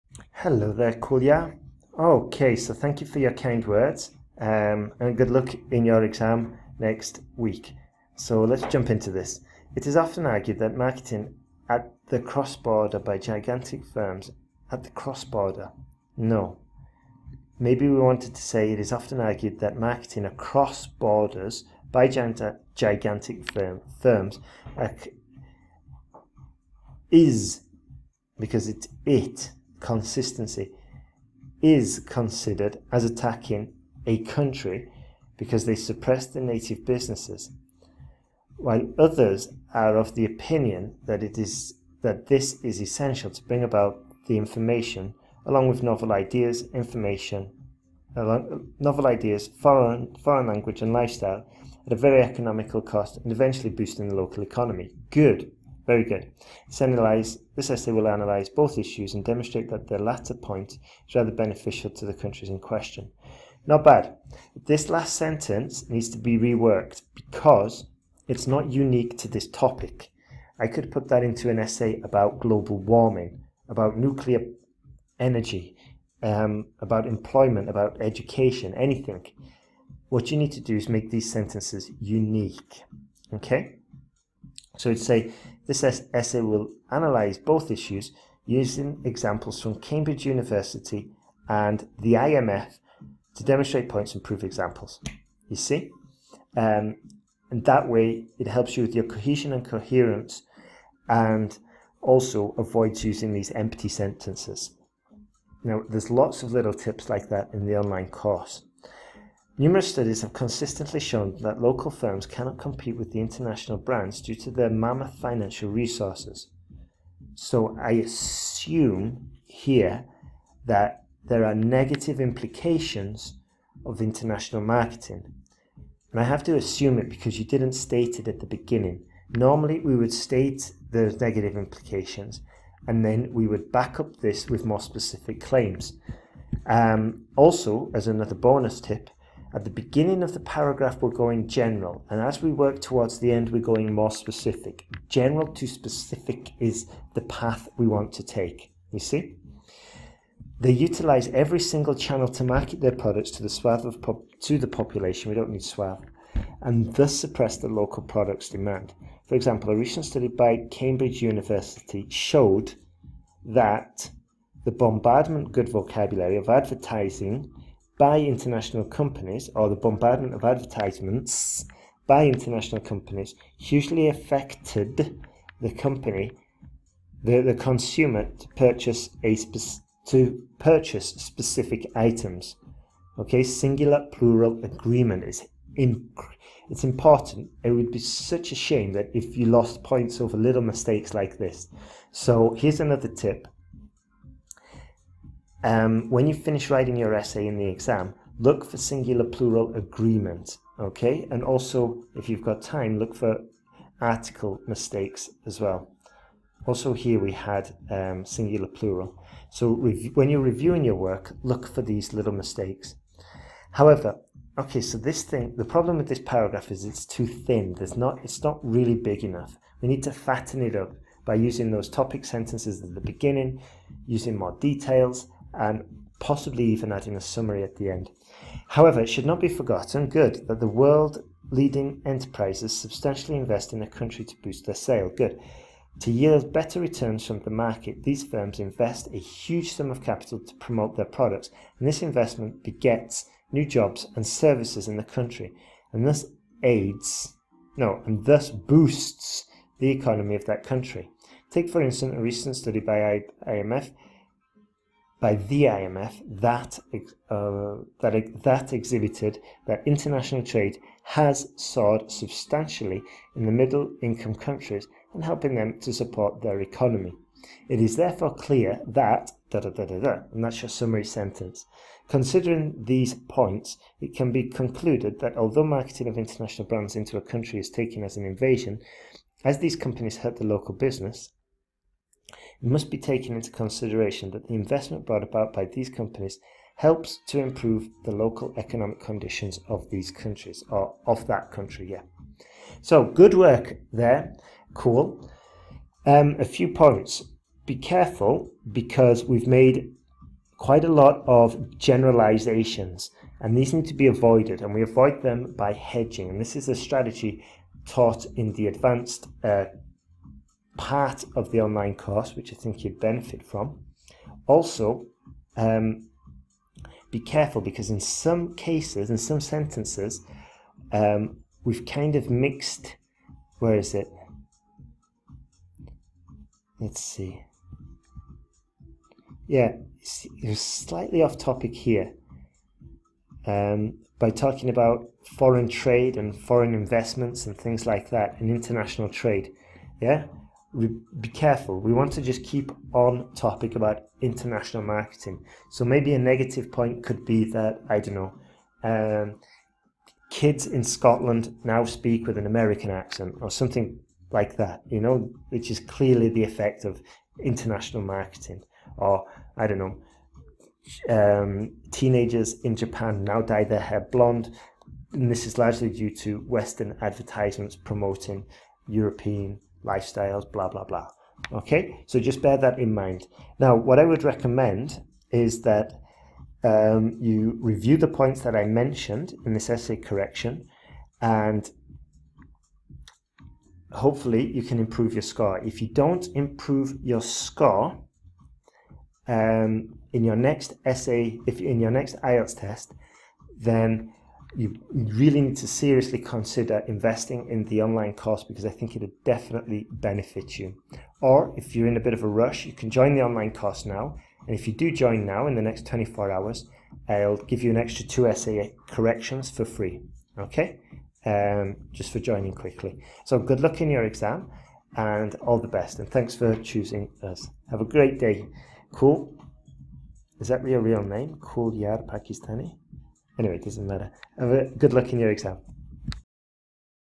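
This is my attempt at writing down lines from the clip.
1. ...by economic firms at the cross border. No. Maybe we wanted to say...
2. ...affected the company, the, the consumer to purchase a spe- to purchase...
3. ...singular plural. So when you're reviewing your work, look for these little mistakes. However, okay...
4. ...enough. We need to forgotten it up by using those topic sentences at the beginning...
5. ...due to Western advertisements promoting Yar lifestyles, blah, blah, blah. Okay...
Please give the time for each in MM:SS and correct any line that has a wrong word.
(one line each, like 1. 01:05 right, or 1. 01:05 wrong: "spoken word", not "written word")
1. 00:12 wrong: "gigantic", not "economic"
2. 02:54 right
3. 03:28 right
4. 03:39 wrong: "fatten", not "forgotten"
5. 06:05 wrong: "European", not "Yar".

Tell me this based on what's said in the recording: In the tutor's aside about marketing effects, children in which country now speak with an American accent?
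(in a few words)
Scotland.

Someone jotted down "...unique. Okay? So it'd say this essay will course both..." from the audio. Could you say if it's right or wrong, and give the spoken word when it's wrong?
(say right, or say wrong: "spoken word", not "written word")
wrong: "analyse", not "course".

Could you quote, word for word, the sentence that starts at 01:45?
Now, there's lots of little tips like that in the online course.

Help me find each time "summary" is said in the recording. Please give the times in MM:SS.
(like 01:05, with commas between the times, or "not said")
03:47, 04:30.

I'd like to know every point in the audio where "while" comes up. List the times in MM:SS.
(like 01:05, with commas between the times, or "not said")
00:38.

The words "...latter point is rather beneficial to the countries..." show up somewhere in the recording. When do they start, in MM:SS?
00:59.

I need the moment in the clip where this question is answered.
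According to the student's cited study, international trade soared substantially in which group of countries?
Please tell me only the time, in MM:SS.
04:23.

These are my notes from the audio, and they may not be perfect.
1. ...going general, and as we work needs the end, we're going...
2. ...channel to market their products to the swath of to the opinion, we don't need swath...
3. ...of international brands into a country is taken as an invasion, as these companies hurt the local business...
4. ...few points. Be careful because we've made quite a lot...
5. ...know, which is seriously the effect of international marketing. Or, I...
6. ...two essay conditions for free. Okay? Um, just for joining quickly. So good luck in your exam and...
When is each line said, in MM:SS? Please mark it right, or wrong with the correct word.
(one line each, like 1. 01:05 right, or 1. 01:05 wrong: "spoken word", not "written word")
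1. 02:21 wrong: "towards", not "needs"
2. 02:31 wrong: "population", not "opinion"
3. 04:36 right
4. 04:56 right
5. 05:55 wrong: "clearly", not "seriously"
6. 06:48 wrong: "corrections", not "conditions".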